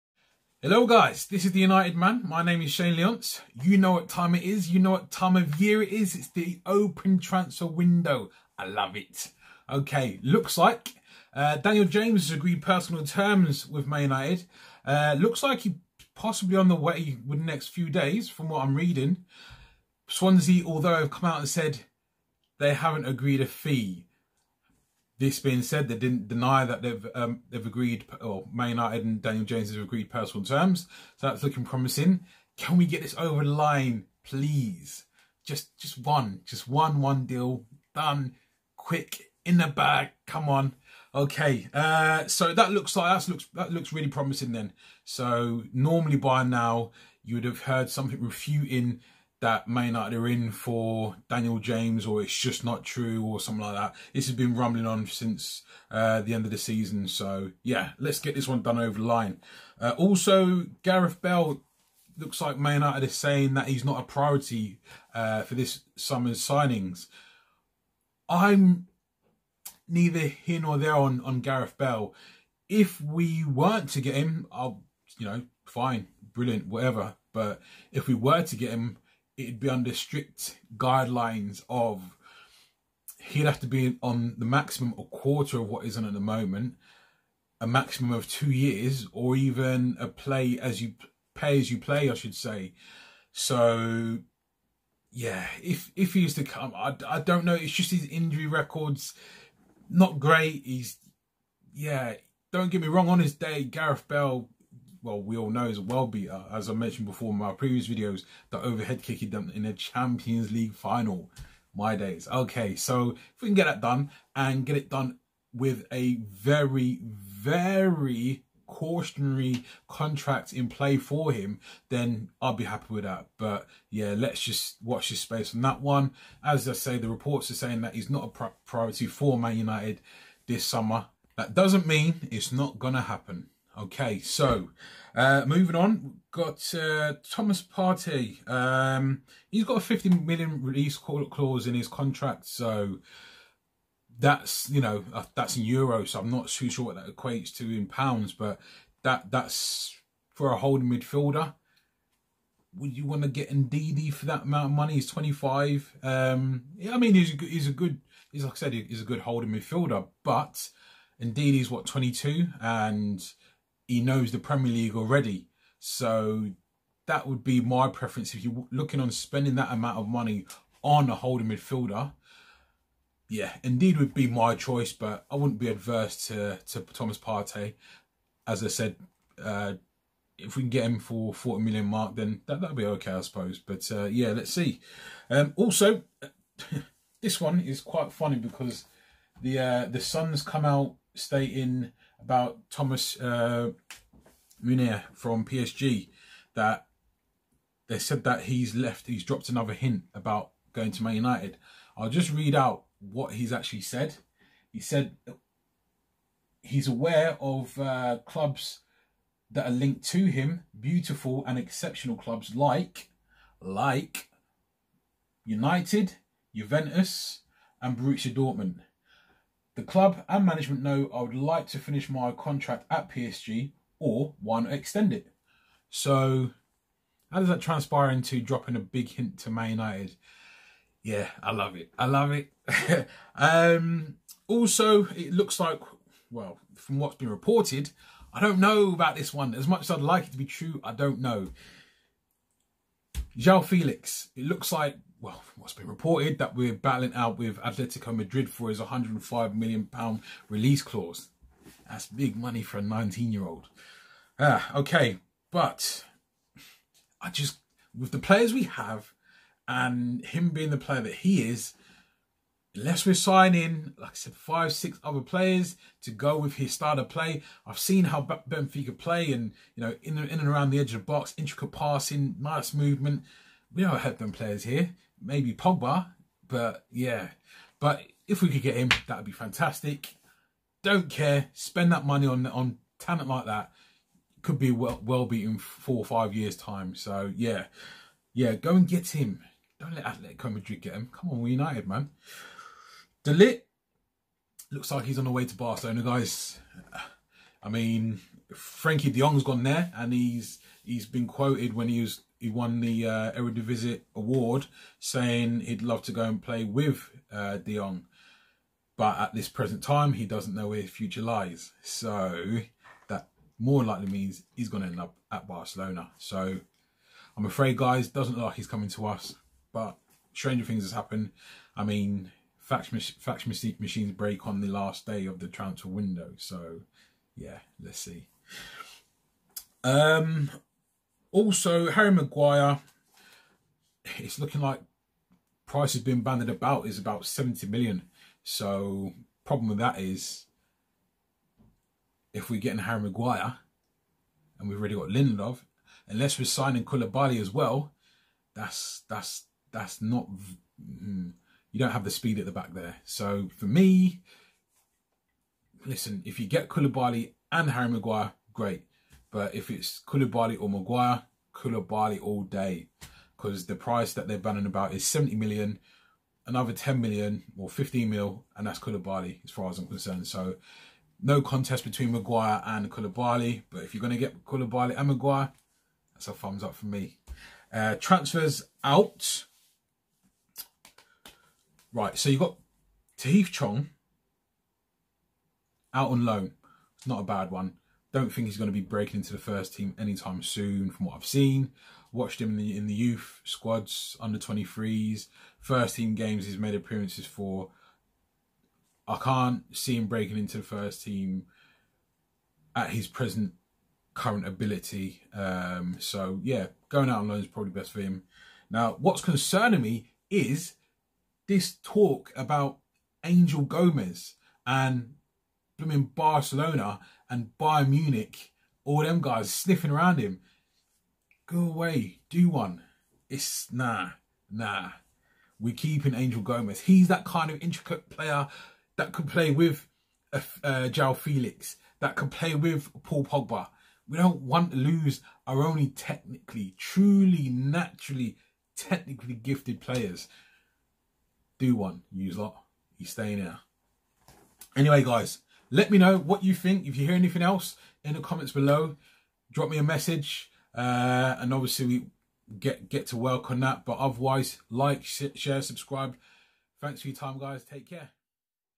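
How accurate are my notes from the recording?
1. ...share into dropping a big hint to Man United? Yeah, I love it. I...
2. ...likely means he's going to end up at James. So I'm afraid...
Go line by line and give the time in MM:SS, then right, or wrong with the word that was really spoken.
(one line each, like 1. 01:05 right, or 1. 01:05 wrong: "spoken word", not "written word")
1. 03:47 wrong: "transpire", not "share"
2. 05:13 wrong: "Barcelona", not "James".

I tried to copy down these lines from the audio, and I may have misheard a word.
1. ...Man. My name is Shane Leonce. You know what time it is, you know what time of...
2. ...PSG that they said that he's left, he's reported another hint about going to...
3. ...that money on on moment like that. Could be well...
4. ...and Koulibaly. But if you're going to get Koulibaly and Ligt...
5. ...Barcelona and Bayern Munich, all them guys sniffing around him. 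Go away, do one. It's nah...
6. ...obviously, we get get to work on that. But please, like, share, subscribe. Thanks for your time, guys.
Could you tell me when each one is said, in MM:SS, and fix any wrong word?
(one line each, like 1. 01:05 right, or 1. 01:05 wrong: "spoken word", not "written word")
1. 00:01 right
2. 03:15 wrong: "dropped", not "reported"
3. 04:41 wrong: "talent", not "moment"
4. 06:12 wrong: "Maguire", not "Ligt"
5. 06:56 right
6. 07:31 wrong: "otherwise", not "please".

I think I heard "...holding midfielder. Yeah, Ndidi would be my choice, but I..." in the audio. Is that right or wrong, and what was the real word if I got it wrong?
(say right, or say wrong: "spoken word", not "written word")
right.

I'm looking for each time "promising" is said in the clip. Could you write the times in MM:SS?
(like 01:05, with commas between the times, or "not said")
00:31, 00:44.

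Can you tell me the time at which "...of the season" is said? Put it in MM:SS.
00:56.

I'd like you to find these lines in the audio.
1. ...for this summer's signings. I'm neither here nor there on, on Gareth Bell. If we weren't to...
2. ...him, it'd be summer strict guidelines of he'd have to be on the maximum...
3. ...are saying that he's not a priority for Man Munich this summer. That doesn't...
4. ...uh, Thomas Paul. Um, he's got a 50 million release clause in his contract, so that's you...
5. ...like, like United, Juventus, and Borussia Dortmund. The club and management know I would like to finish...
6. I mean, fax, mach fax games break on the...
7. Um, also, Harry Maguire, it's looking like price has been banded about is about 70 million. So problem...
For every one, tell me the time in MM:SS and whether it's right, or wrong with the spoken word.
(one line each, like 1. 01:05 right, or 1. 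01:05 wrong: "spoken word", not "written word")
1. 01:05 right
2. 01:18 wrong: "under", not "summer"
3. 02:07 wrong: "United", not "Munich"
4. 02:16 wrong: "Partey", not "Paul"
5. 03:32 right
6. 05:21 wrong: "machines", not "games"
7. 05:29 right.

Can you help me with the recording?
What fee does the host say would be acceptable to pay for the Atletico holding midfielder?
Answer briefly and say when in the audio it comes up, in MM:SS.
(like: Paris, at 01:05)
40 million, at 03:01.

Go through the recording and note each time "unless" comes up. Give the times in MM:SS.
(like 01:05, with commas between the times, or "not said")
04:22, 05:46.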